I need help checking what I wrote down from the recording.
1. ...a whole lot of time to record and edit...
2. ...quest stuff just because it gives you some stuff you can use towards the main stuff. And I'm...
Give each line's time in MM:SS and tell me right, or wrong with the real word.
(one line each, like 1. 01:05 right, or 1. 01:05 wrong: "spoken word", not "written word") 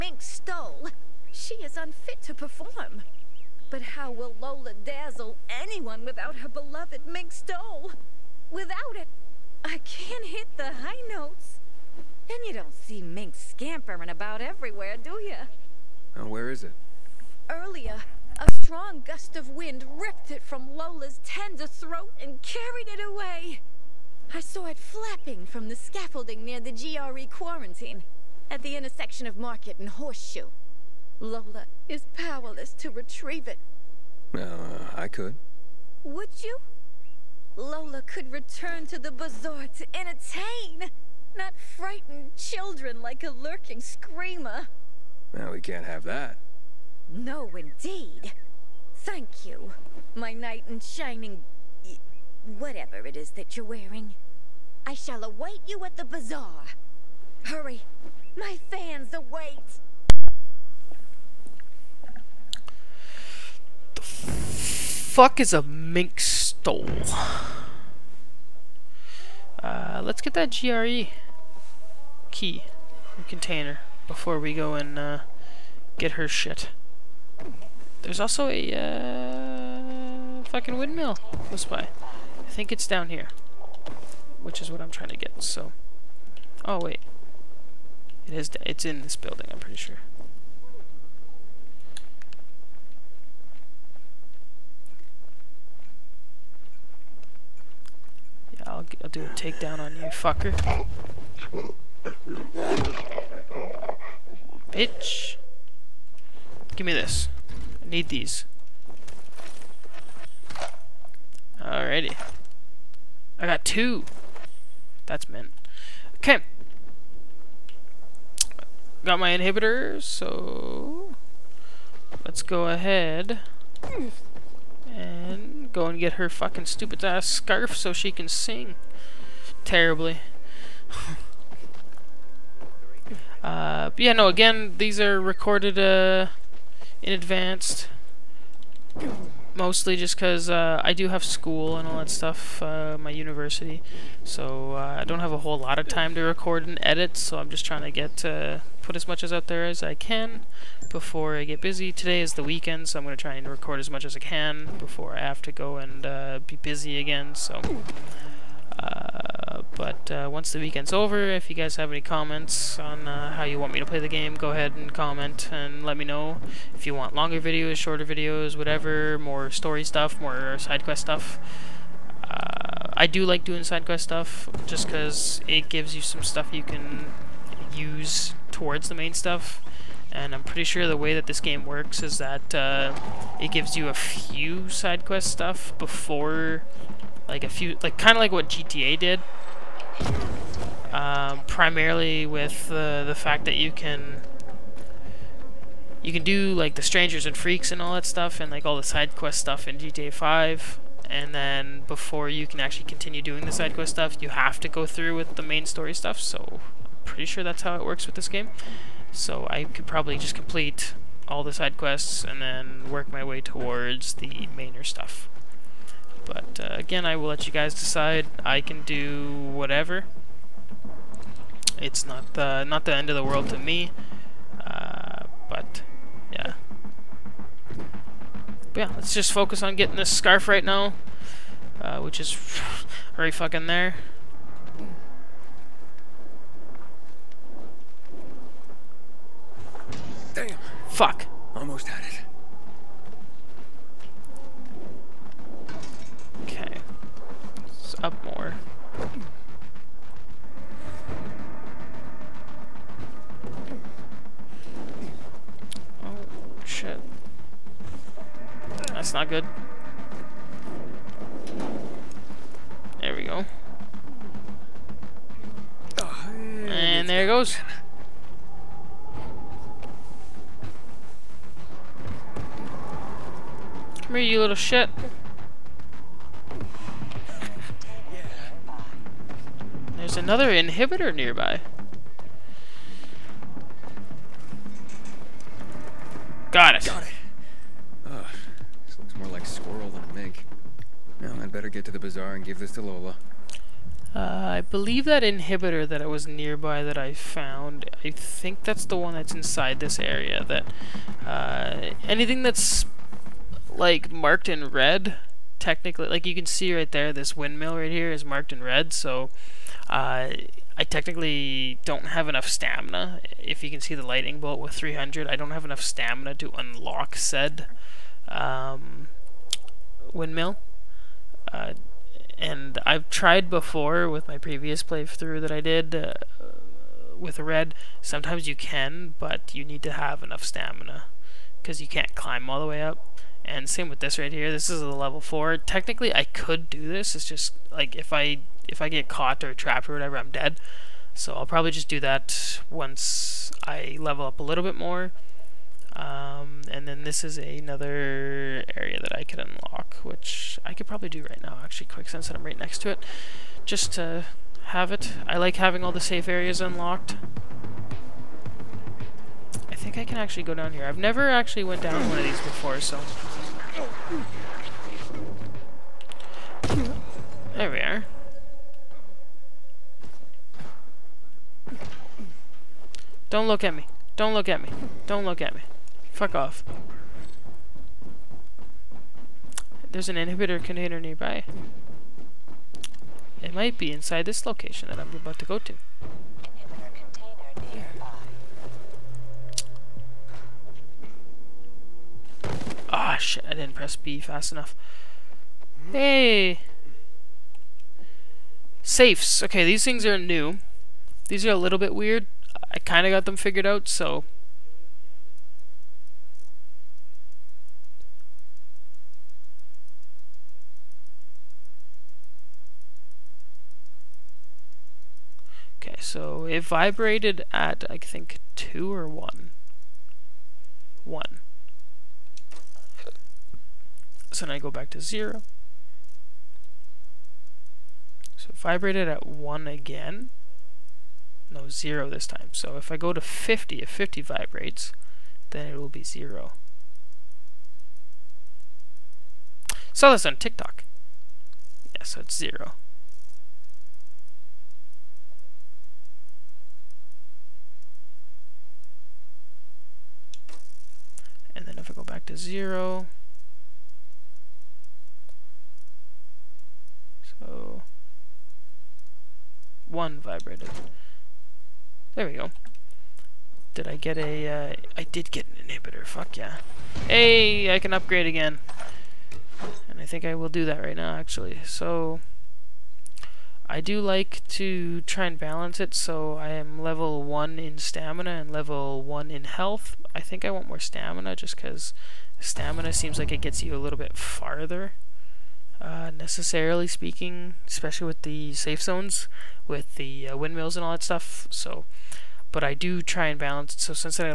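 1. 02:25 right
2. 02:53 right.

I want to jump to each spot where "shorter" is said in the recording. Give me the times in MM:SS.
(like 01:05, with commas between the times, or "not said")
02:47.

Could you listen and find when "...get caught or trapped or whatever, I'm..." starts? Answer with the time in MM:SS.
05:38.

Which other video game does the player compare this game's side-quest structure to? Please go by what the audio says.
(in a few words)
GTA 5.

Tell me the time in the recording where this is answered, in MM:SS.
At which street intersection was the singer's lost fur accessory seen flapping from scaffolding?
00:29.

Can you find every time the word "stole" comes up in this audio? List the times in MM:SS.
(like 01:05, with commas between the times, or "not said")
00:00, 00:07, 01:06.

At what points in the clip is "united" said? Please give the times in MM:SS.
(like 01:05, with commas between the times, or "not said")
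not said.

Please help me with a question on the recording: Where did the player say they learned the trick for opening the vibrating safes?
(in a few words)
TikTok.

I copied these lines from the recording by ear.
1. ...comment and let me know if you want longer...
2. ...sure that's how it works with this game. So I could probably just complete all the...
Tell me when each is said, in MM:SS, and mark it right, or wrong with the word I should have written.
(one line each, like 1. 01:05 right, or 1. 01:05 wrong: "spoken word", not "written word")
1. 02:44 right
2. 03:27 right.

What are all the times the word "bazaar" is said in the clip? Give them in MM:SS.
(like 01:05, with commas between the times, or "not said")
00:39, 00:56, 04:51.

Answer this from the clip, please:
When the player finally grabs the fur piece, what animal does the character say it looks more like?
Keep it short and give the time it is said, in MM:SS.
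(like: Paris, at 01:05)
squirrel, at 04:49.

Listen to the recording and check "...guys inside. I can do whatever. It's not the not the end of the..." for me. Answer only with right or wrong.
wrong.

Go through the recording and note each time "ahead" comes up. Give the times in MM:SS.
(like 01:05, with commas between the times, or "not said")
02:02, 02:44.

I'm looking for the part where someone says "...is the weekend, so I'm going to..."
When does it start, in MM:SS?
02:32.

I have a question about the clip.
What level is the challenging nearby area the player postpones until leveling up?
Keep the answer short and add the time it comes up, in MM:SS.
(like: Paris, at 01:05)
level 4, at 05:34.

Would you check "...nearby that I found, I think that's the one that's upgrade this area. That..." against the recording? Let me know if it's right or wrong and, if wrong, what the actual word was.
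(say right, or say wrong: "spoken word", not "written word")
wrong: "inside", not "upgrade".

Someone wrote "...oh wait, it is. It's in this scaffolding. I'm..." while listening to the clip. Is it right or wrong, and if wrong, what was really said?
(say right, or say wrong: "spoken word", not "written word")
wrong: "building", not "scaffolding".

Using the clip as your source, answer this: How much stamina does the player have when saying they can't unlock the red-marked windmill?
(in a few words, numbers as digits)
300.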